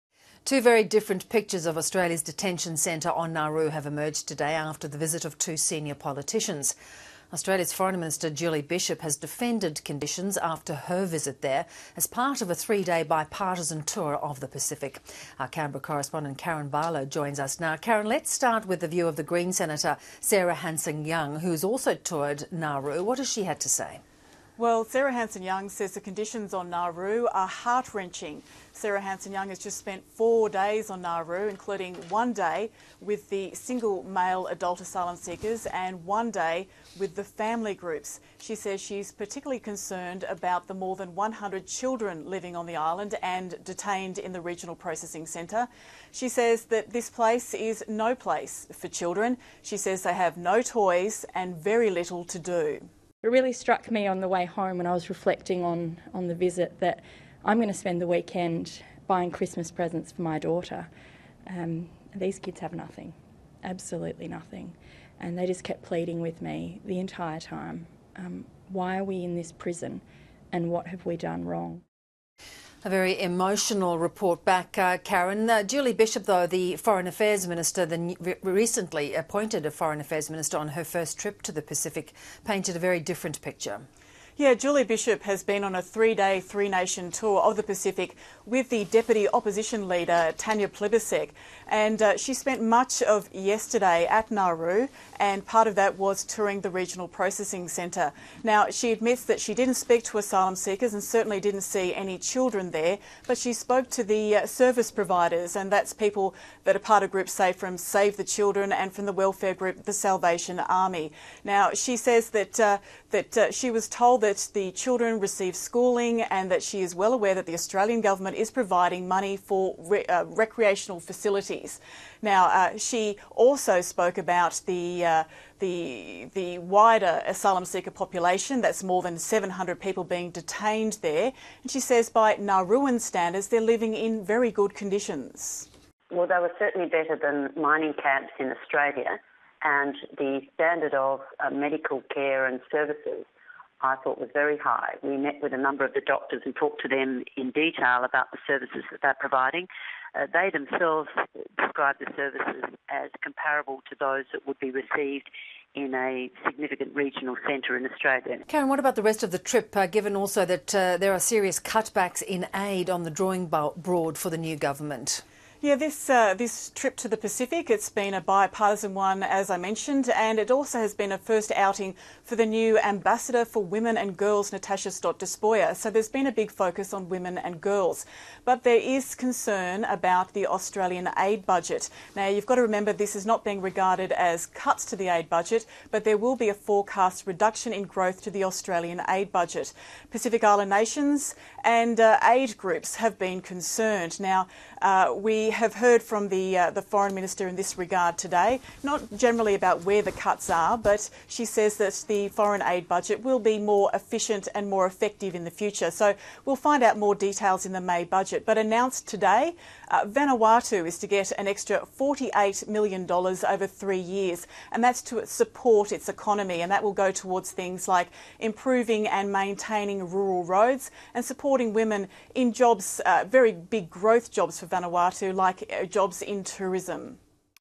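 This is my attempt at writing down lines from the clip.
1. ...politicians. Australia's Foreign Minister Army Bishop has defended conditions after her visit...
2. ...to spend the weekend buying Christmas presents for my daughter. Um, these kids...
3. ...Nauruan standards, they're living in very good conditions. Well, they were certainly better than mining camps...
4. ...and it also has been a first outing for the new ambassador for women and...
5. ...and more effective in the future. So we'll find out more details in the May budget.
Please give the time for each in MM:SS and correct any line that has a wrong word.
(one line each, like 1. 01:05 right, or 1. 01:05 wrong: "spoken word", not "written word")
1. 00:05 wrong: "Julie", not "Army"
2. 00:57 right
3. 02:12 right
4. 02:50 right
5. 03:24 right.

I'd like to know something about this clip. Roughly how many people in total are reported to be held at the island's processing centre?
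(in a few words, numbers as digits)
more than 700.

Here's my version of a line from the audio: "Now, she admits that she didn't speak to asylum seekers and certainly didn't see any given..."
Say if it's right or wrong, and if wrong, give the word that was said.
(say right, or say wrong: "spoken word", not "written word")
wrong: "children", not "given".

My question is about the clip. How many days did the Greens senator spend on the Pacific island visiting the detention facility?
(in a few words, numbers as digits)
4.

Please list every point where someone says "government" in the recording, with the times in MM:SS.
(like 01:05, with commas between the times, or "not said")
01:57, 02:44.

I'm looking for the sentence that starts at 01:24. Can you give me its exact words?
Yeah, Julie Bishop has been on a three day, three nation tour of the Pacific with the Deputy Opposition Leader, Tanya Plibersek.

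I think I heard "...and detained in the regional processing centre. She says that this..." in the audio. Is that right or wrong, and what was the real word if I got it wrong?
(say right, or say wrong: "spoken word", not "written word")
right.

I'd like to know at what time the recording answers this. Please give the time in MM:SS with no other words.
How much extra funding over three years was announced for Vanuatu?
03:31.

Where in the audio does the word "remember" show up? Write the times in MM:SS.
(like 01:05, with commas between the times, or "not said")
03:02.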